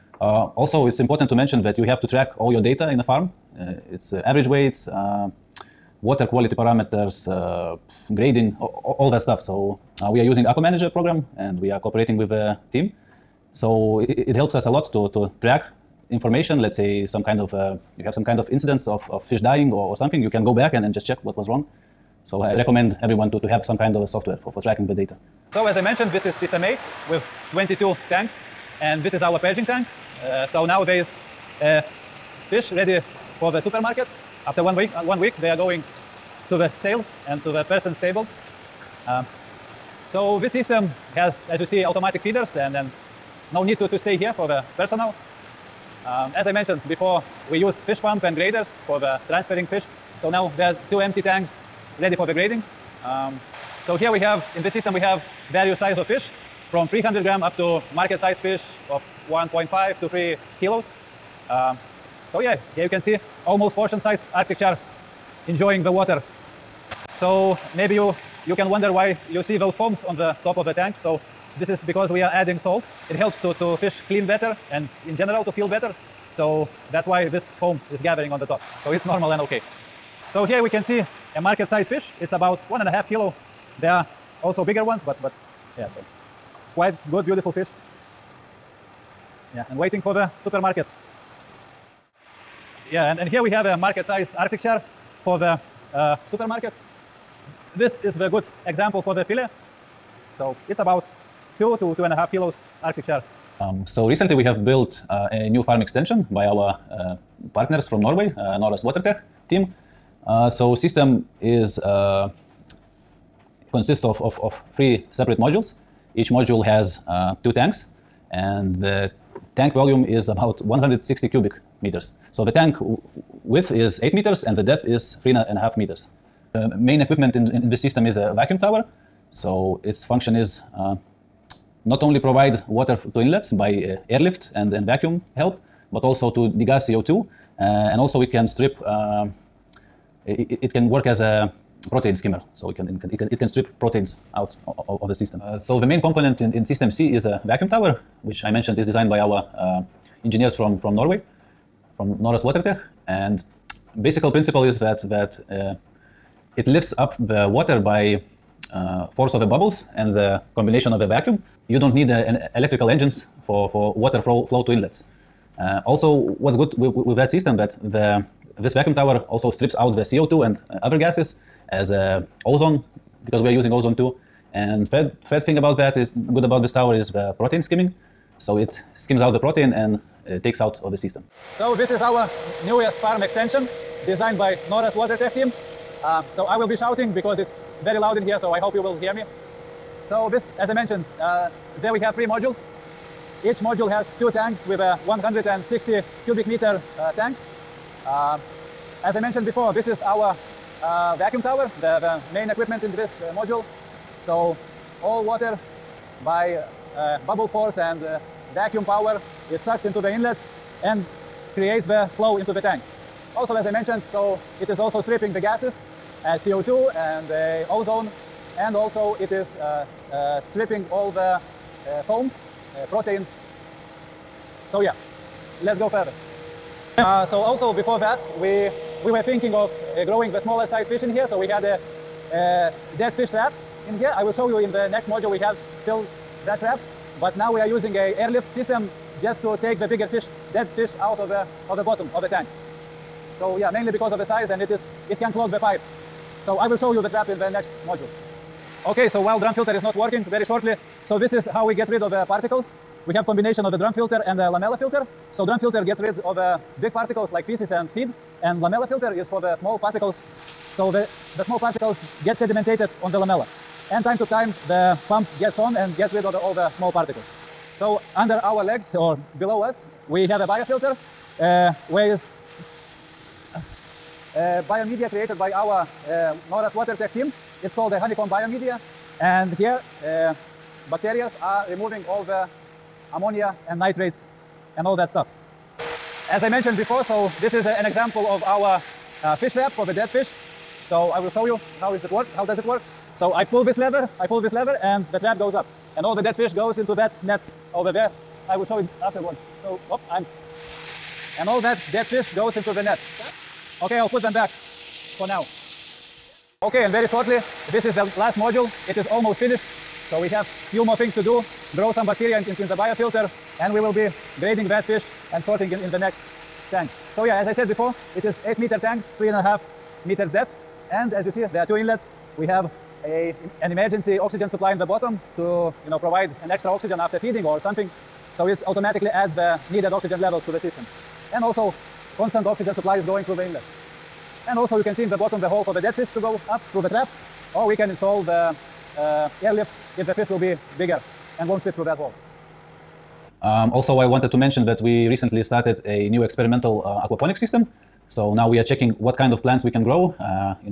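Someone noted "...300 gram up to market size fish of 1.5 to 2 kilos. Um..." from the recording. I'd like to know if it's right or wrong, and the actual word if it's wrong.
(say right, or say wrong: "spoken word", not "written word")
wrong: "3", not "2".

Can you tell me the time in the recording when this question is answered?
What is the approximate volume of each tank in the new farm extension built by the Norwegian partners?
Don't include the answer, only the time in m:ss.
2:00.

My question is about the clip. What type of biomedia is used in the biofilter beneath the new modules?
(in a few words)
honeycomb biomedia.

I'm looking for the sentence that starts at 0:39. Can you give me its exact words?
Um, so this system has, as you see, automatic feeders and then no need to, to stay here for the personnel.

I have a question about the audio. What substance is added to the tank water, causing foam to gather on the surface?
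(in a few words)
salt.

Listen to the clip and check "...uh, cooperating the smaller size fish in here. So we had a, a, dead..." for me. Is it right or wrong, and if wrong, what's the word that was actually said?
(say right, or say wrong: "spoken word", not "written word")
wrong: "growing", not "cooperating".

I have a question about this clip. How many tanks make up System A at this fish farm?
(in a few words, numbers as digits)
22.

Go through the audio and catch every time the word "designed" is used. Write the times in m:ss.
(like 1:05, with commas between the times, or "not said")
2:28, 3:04.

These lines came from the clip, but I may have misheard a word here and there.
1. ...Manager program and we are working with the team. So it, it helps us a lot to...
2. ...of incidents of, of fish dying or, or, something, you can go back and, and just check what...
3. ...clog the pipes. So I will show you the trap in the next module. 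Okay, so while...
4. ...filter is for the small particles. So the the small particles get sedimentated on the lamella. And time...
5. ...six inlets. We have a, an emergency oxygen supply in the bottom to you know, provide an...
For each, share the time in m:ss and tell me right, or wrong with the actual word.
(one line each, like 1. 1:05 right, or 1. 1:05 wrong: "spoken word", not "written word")
1. 0:10 wrong: "cooperating", not "working"
2. 0:18 right
3. 4:05 right
4. 4:18 right
5. 5:21 wrong: "two", not "six".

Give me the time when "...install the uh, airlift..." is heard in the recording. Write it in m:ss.
5:37.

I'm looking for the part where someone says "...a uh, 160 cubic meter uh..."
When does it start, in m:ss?
3:14.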